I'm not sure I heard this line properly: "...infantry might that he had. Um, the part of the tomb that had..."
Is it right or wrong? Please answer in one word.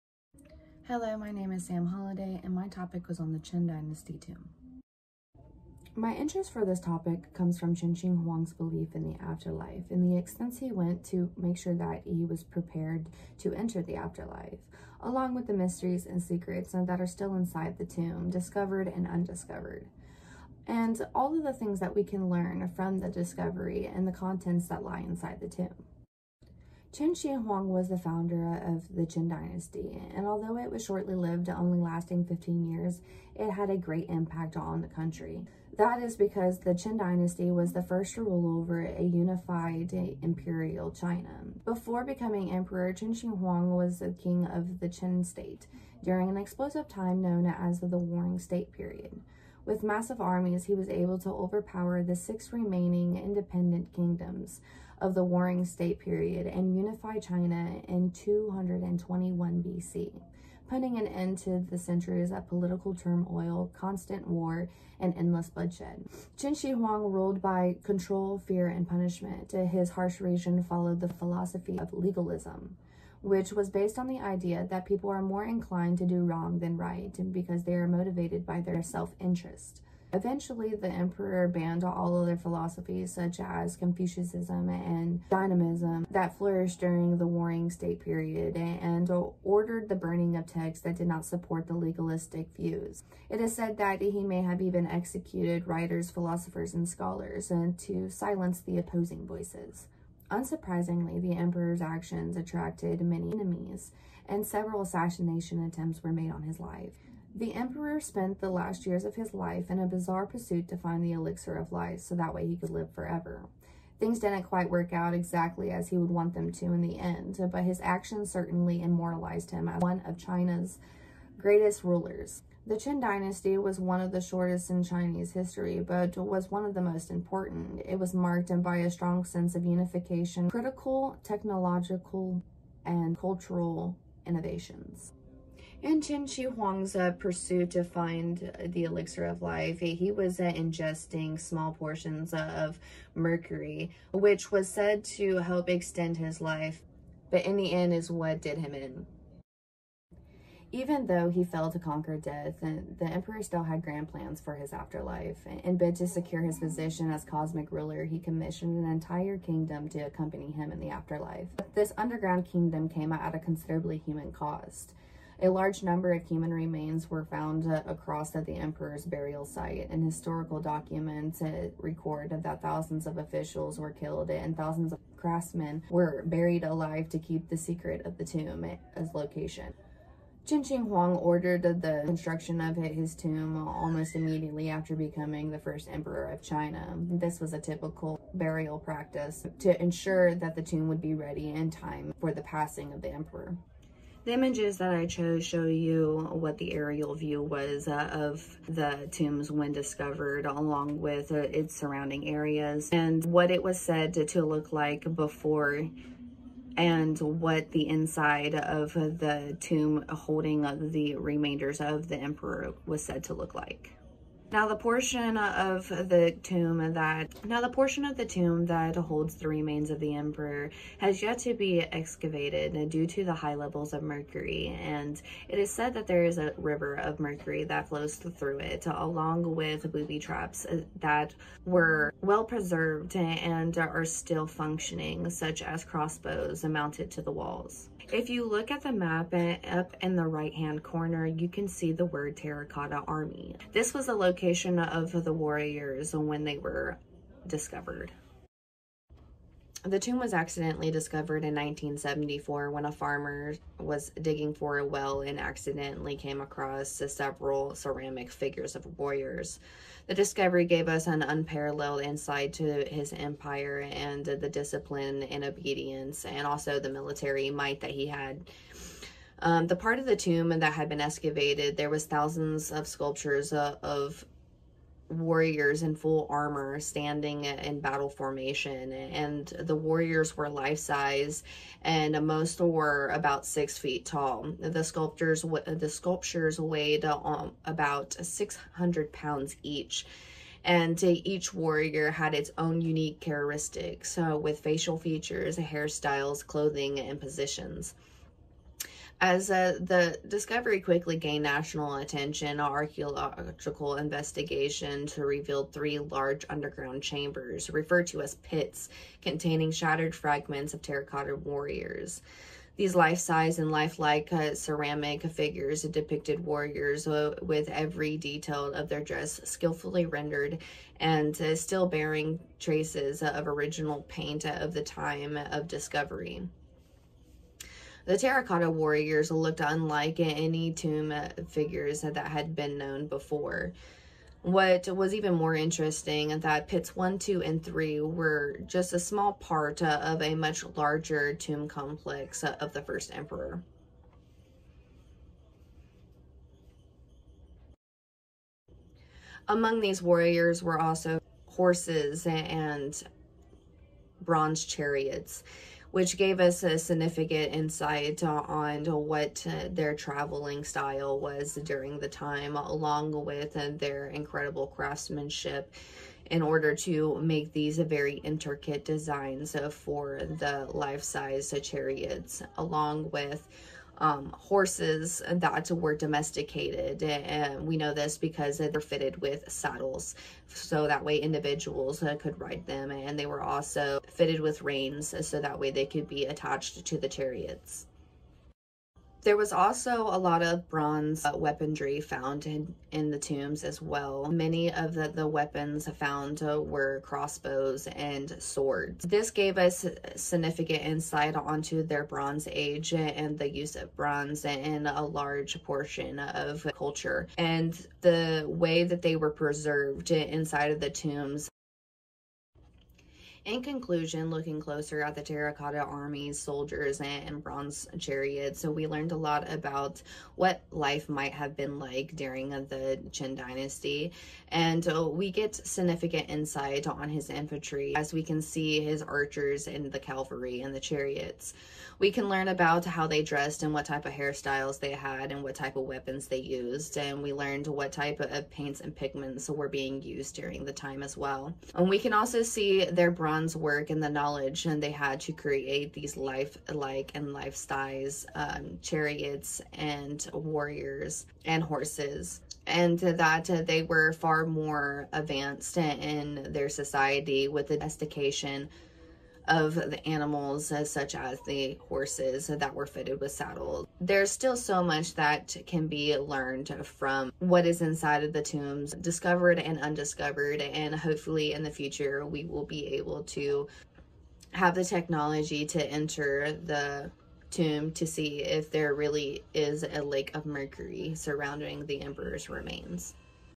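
wrong.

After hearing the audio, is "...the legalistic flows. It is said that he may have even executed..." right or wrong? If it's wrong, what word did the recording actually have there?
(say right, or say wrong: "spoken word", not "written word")
wrong: "views", not "flows".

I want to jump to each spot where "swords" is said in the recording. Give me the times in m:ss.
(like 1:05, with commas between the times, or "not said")
6:38.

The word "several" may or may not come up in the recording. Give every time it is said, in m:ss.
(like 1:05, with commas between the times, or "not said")
1:44, 4:17.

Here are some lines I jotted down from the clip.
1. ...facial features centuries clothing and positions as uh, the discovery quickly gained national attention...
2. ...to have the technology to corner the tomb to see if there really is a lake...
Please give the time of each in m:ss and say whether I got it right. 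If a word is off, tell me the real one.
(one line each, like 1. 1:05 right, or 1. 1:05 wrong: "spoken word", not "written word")
1. 4:54 wrong: "hairstyles", not "centuries"
2. 7:53 wrong: "enter", not "corner".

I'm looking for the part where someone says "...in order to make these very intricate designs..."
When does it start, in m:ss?
6:06.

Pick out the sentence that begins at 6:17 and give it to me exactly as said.
And we know this because they're fitted with saddles.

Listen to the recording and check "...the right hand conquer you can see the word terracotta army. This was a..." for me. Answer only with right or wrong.
wrong.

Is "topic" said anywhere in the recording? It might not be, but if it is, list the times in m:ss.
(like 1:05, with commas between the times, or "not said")
0:02, 0:06.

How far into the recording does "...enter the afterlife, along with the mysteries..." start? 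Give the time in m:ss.
0:13.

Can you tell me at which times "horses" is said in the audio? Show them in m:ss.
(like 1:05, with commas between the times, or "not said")
5:51, 6:14, 7:31, 7:41.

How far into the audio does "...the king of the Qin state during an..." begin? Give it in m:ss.
0:43.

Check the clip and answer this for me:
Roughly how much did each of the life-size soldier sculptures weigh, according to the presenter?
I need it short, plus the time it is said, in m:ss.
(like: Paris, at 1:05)
600 pounds, at 4:48.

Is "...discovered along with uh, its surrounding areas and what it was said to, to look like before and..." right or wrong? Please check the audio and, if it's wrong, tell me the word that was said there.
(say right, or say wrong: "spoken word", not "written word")
right.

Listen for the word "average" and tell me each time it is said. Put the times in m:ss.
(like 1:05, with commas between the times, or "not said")
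not said.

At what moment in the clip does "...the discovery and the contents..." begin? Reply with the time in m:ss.
0:22.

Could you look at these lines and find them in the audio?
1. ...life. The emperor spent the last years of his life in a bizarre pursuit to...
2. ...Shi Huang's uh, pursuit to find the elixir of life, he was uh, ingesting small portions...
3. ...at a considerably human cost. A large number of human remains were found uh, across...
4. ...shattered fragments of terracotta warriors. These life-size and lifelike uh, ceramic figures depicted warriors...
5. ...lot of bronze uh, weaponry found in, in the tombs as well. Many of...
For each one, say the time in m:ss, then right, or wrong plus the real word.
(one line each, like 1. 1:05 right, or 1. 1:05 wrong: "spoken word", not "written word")
1. 1:46 right
2. 2:16 right
3. 2:43 right
4. 5:09 right
5. 6:30 right.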